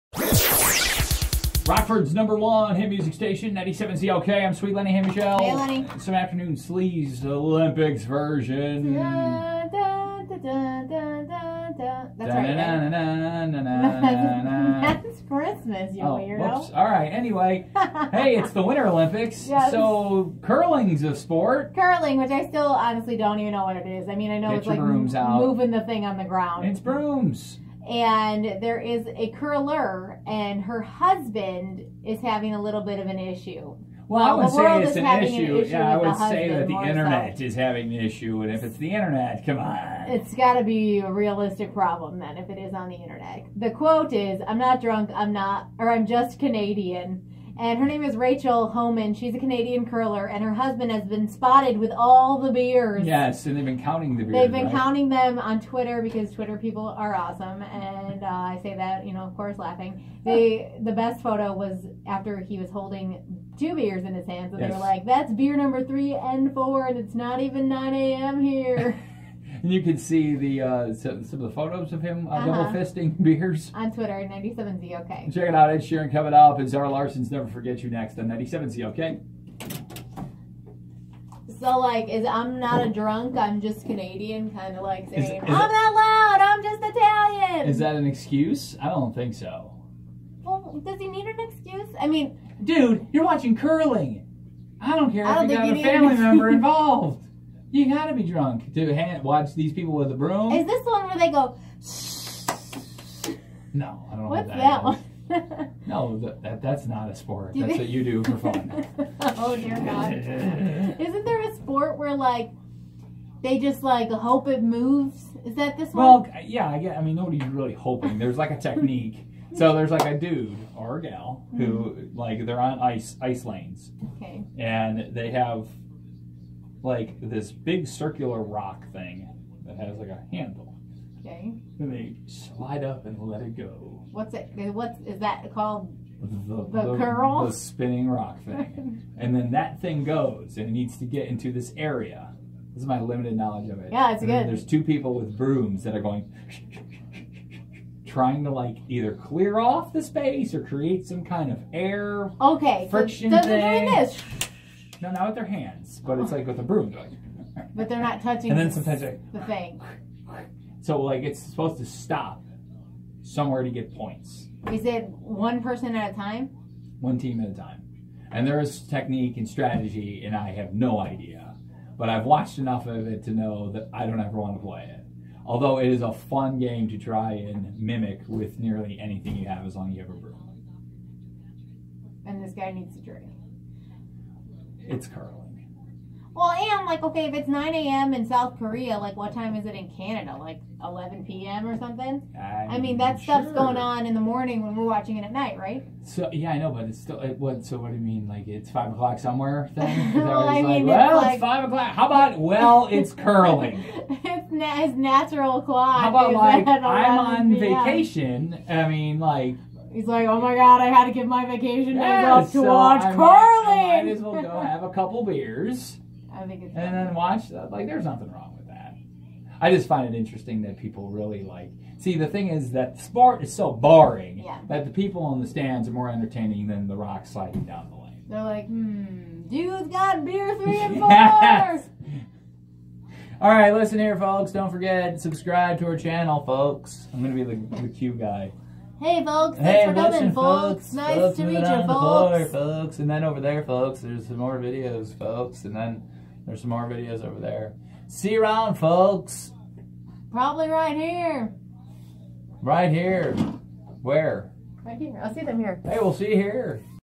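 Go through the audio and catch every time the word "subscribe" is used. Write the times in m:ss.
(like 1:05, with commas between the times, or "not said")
3:55.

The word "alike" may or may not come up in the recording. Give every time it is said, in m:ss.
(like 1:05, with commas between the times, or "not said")
not said.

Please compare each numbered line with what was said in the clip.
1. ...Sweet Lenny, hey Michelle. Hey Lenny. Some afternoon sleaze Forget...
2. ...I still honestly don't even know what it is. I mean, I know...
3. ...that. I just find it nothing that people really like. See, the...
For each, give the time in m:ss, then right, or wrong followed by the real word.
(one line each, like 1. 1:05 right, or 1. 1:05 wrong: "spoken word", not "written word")
1. 0:04 wrong: "Olympics", not "Forget"
2. 0:22 right
3. 3:38 wrong: "interesting", not "nothing".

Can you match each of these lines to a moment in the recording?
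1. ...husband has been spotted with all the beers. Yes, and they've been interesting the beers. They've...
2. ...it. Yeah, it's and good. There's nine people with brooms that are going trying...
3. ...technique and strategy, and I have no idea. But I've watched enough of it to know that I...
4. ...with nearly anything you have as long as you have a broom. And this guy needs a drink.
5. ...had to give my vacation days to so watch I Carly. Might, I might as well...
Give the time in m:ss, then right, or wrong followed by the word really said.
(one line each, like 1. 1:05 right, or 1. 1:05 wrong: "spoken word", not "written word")
1. 0:50 wrong: "counting", not "interesting"
2. 2:23 wrong: "two", not "nine"
3. 2:48 right
4. 2:58 right
5. 3:30 right.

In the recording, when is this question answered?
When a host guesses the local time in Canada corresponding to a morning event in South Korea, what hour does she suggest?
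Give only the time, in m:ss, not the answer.
3:10.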